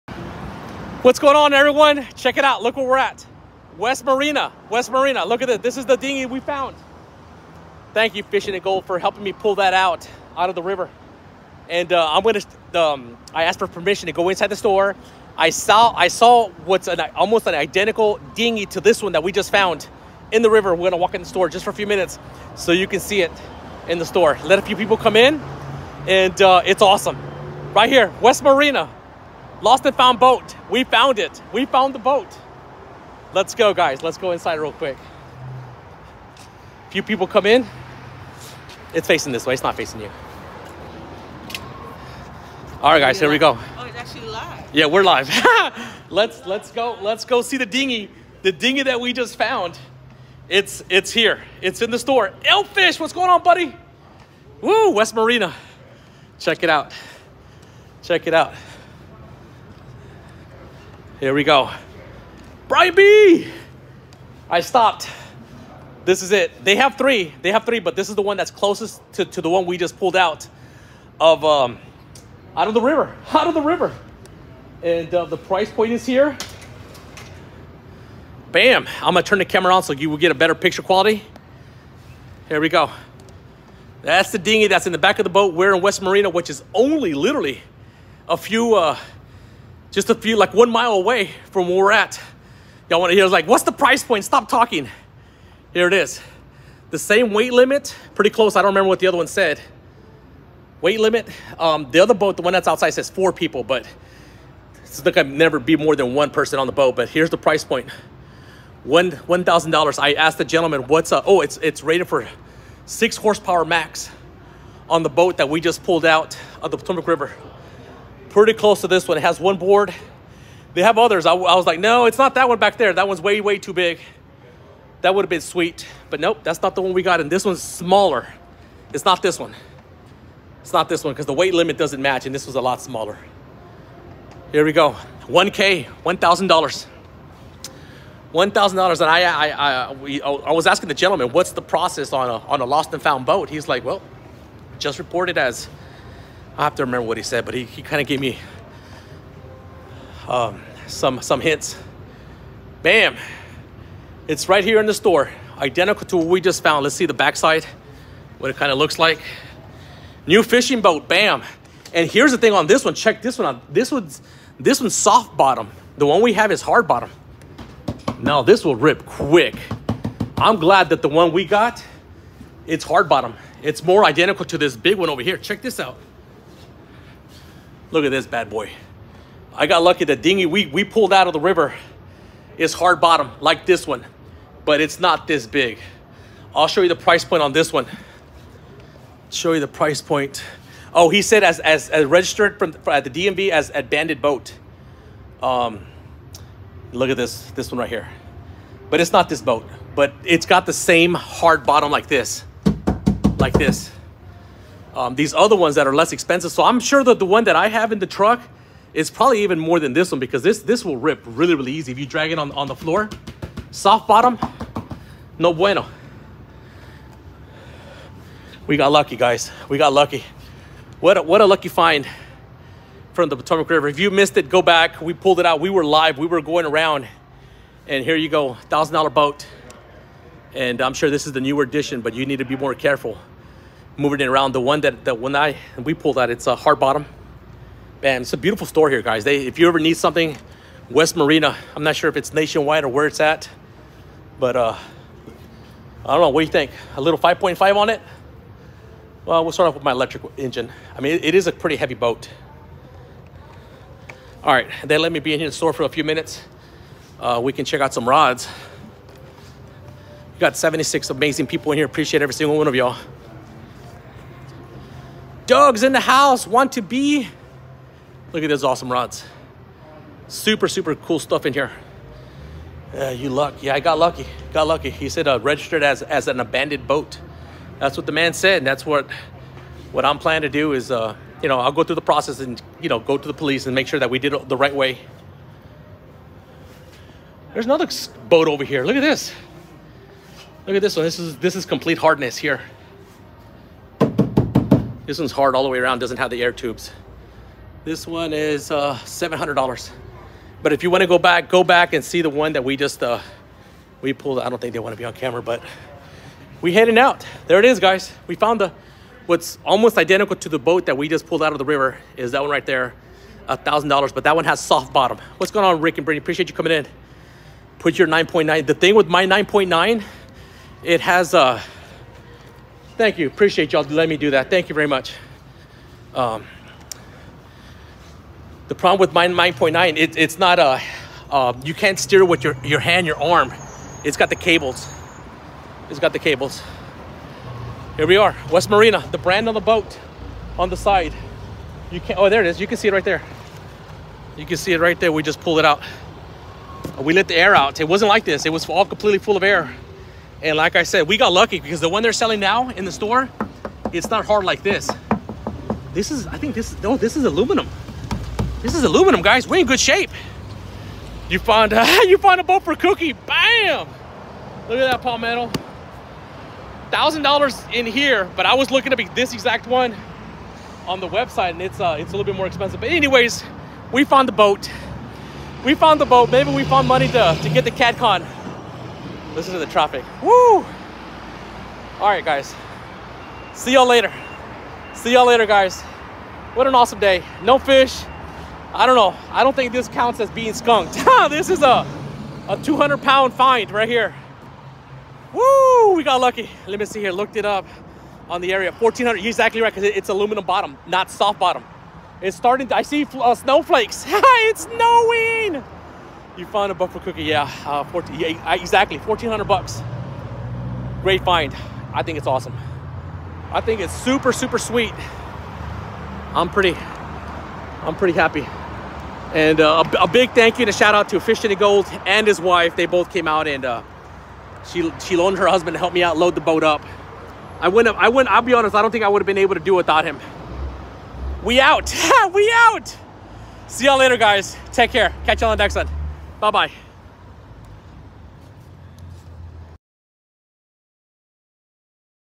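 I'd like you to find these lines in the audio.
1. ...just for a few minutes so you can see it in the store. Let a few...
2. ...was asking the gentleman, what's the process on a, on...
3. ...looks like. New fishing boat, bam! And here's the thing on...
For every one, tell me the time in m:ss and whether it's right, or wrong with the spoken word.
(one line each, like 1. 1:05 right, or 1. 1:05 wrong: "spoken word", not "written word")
1. 0:21 right
2. 2:20 right
3. 2:38 right.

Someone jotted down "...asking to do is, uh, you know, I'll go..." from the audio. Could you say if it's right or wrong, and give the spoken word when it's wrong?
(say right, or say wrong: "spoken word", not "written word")
wrong: "planning", not "asking".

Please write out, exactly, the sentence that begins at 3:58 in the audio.
Man, it's a beautiful store here, guys.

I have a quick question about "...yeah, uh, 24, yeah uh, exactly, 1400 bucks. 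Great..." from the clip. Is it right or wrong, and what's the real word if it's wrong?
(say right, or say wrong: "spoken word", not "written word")
wrong: "14", not "24".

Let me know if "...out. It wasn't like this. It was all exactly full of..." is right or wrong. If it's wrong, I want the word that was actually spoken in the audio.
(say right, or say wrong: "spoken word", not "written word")
wrong: "completely", not "exactly".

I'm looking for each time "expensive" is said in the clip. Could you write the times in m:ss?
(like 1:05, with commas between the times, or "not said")
3:26, 6:12.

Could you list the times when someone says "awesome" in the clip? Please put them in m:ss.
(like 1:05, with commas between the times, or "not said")
0:26, 4:28, 6:26, 6:52.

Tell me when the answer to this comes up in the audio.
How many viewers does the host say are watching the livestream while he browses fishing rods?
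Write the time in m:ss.
4:20.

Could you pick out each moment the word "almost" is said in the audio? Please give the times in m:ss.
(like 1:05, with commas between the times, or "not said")
0:17, 5:09.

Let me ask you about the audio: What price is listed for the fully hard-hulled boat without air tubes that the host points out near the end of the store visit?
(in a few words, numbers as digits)
$700.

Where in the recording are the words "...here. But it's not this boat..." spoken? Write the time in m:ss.
3:17.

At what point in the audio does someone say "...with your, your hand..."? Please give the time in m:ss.
5:32.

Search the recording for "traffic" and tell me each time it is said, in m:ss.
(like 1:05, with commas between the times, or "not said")
6:19.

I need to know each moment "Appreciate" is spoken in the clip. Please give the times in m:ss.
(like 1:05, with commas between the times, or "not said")
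4:21, 5:16, 5:23.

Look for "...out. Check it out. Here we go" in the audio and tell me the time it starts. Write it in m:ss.
0:56.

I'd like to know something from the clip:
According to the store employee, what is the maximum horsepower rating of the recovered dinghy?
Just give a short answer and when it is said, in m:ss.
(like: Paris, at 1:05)
6, at 1:52.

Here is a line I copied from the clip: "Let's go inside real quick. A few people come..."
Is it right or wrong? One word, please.
right.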